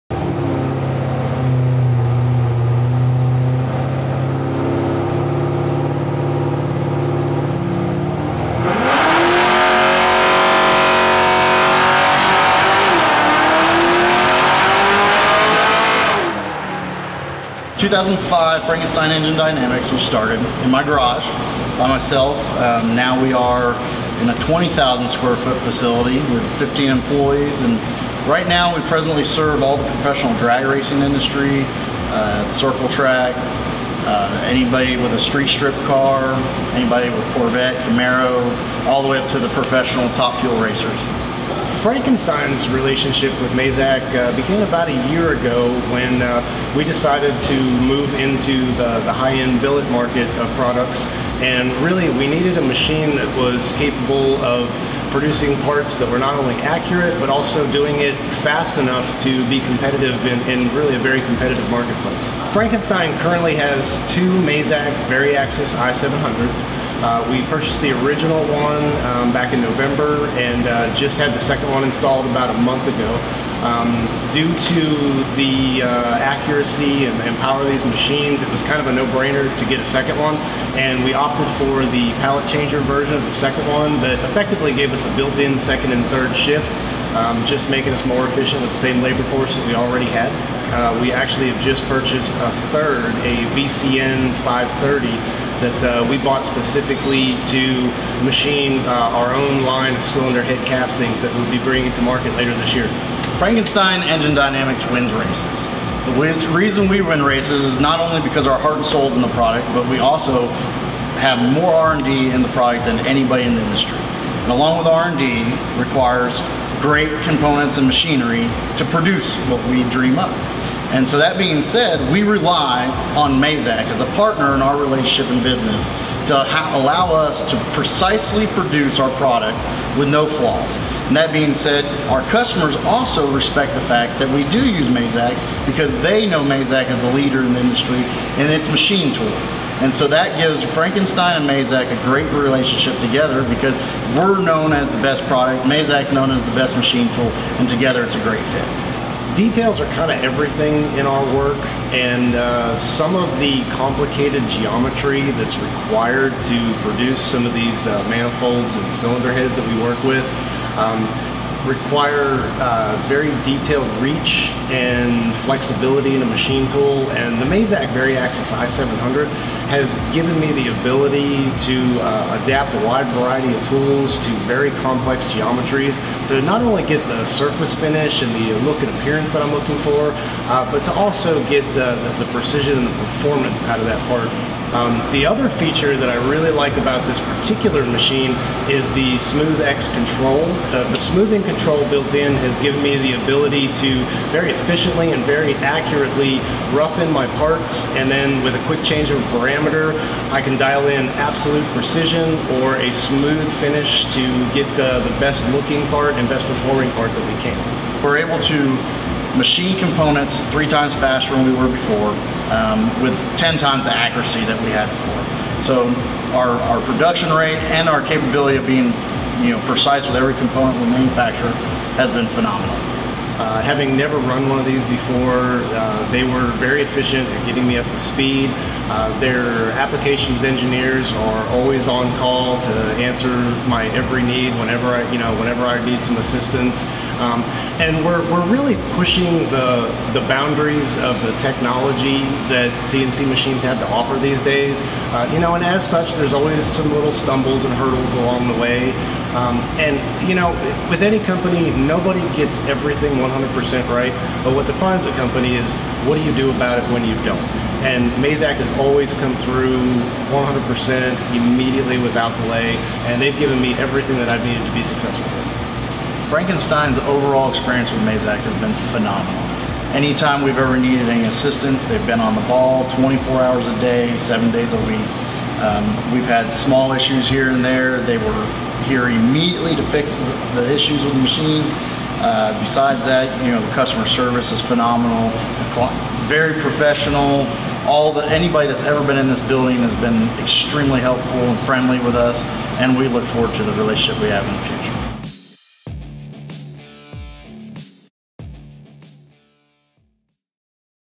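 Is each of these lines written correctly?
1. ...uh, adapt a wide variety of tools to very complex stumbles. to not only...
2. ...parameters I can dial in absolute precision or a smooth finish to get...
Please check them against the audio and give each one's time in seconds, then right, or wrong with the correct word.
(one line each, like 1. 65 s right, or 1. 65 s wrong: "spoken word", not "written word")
1. 172 s wrong: "geometries", not "stumbles"
2. 199 s right.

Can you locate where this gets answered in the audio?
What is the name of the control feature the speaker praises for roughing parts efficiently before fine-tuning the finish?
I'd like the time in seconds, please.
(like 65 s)
189 s.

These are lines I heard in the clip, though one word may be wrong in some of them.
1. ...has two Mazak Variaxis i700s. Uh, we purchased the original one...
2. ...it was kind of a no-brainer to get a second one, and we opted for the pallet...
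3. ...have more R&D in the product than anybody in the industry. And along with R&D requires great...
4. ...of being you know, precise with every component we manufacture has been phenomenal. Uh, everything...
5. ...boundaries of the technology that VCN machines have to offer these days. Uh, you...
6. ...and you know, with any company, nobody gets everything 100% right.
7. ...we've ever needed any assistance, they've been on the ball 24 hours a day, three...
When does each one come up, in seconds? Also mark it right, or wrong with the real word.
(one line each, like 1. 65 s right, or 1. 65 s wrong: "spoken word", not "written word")
1. 63 s right
2. 78 s right
3. 111 s right
4. 218 s wrong: "having", not "everything"
5. 240 s wrong: "CNC", not "VCN"
6. 249 s right
7. 270 s wrong: "seven", not "three".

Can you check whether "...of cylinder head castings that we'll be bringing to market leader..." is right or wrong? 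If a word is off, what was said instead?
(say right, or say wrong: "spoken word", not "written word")
wrong: "later", not "leader".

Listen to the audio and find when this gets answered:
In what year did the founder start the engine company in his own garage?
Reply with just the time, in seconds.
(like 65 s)
17 s.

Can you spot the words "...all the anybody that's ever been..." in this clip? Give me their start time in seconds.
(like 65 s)
287 s.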